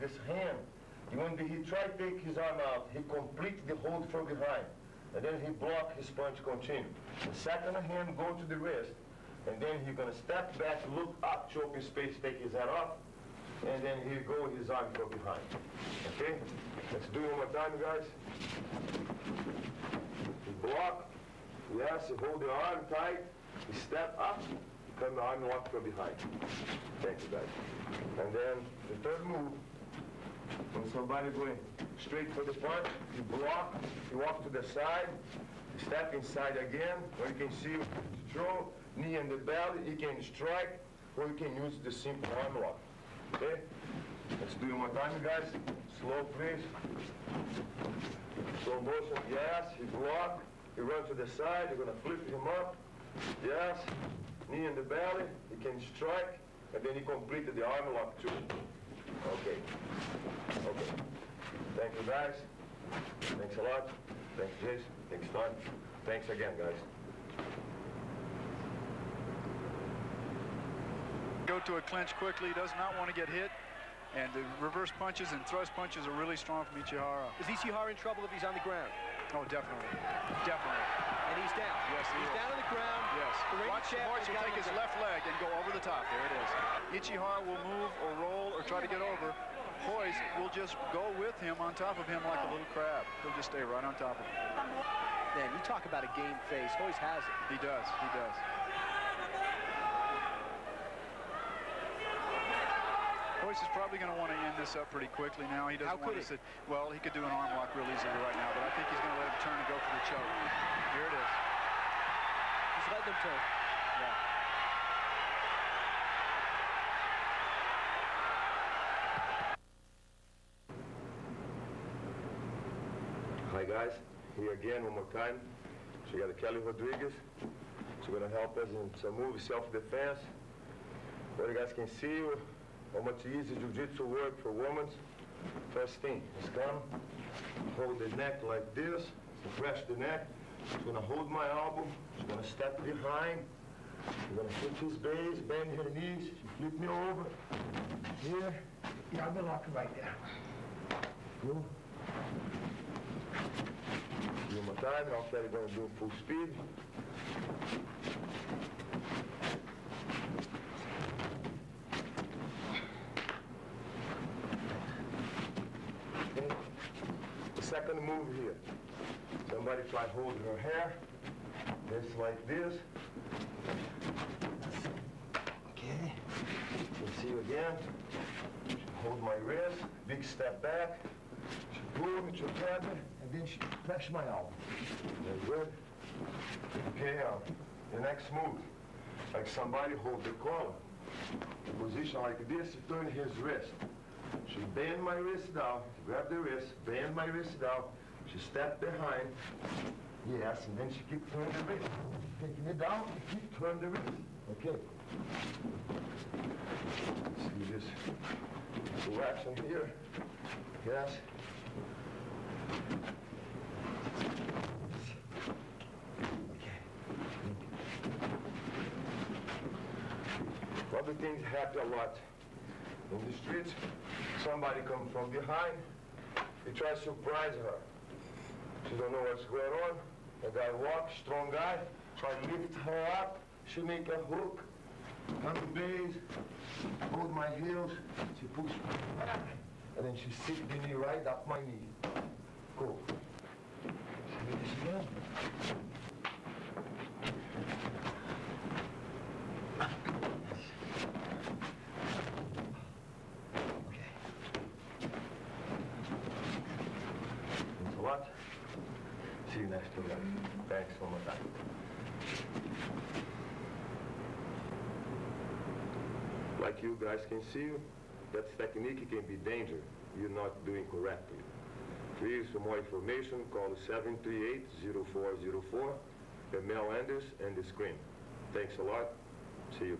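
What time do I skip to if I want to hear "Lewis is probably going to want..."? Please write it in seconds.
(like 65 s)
103 s.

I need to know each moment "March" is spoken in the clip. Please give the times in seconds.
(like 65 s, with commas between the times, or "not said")
83 s.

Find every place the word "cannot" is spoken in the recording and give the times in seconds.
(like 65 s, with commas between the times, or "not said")
not said.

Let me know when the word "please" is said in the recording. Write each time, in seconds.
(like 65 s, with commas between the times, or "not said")
46 s, 272 s.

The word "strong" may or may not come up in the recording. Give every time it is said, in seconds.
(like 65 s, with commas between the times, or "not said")
76 s, 231 s.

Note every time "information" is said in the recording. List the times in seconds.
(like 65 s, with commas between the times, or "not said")
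272 s.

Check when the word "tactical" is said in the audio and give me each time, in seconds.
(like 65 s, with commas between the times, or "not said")
not said.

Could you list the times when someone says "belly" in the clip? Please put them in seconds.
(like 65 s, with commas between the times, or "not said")
39 s, 54 s.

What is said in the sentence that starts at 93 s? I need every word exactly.
He'll just stay right on top of him.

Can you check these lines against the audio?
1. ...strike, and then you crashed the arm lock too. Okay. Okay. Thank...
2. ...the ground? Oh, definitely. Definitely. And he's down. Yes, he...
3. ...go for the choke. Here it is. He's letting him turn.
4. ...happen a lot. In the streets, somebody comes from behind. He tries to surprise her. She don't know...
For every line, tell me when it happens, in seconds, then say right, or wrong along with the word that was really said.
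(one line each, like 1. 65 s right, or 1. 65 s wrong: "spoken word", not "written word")
1. 55 s wrong: "completed", not "crashed"
2. 78 s right
3. 109 s right
4. 221 s right.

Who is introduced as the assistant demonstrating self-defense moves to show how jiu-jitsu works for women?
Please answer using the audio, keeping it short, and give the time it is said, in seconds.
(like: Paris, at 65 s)
Kelli Rodrigues, at 126 s.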